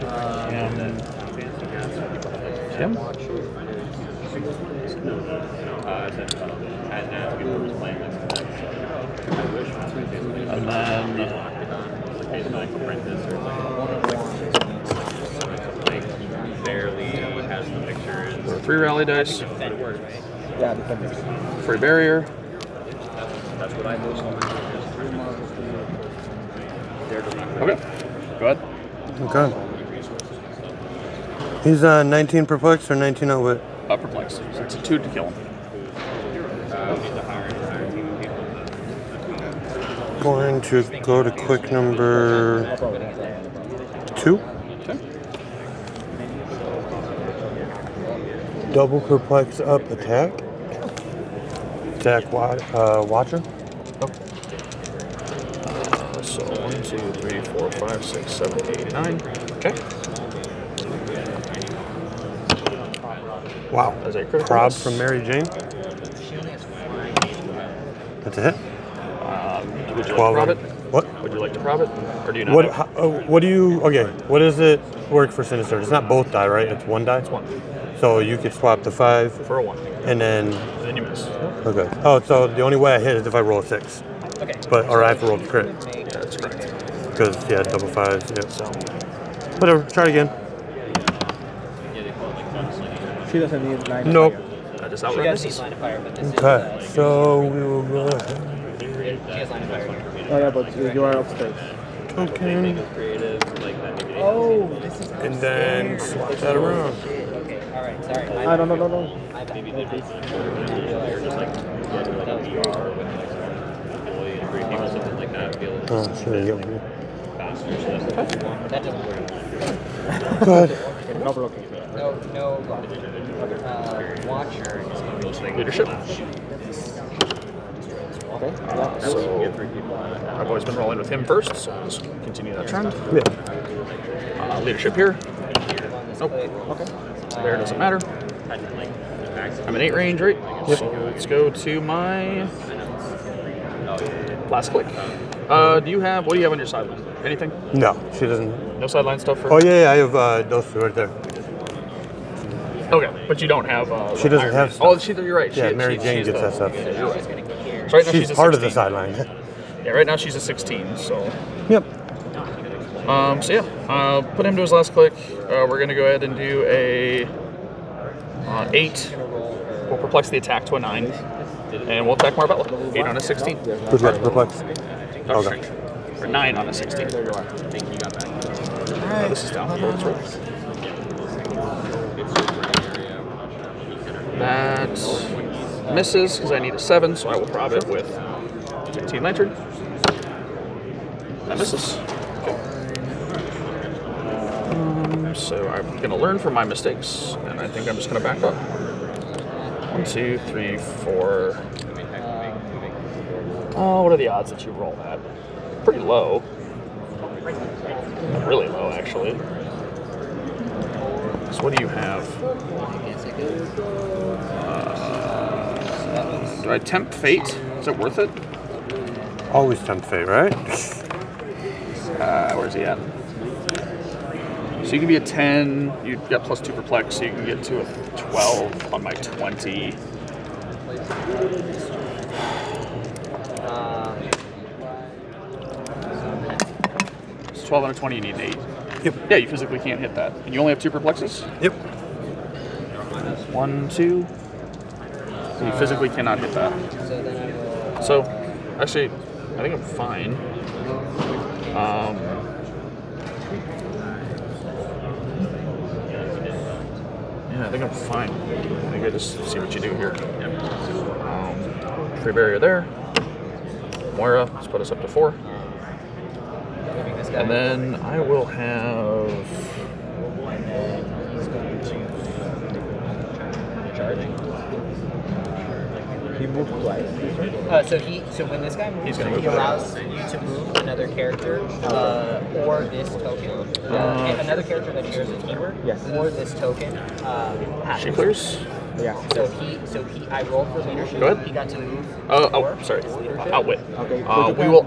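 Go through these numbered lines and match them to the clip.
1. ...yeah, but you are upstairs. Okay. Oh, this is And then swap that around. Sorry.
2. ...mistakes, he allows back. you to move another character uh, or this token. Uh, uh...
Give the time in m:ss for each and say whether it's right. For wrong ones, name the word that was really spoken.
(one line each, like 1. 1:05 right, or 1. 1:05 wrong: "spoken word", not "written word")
1. 1:40 right
2. 4:38 wrong: "moves", not "mistakes".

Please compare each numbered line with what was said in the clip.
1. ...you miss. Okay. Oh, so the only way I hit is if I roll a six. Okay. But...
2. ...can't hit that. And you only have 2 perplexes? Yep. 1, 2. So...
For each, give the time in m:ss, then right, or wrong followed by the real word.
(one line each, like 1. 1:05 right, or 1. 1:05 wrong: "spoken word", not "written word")
1. 1:20 right
2. 3:59 right.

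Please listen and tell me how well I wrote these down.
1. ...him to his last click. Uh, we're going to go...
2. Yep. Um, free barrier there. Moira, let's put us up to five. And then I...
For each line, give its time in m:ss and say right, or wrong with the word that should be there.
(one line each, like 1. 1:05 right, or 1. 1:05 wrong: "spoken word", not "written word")
1. 2:44 right
2. 4:20 wrong: "four", not "five".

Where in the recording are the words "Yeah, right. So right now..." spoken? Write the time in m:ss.
2:36.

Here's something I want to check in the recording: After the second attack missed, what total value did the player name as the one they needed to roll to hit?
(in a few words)
7.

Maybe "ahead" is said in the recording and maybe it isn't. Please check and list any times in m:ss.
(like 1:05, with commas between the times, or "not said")
0:28, 2:46, 4:51.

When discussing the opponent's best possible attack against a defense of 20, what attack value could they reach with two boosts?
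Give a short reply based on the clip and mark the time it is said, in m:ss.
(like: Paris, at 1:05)
12, at 3:47.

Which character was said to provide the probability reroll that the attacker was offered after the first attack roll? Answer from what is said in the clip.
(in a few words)
Mary Jane.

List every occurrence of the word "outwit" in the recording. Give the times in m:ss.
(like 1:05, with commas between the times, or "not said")
0:33, 4:53.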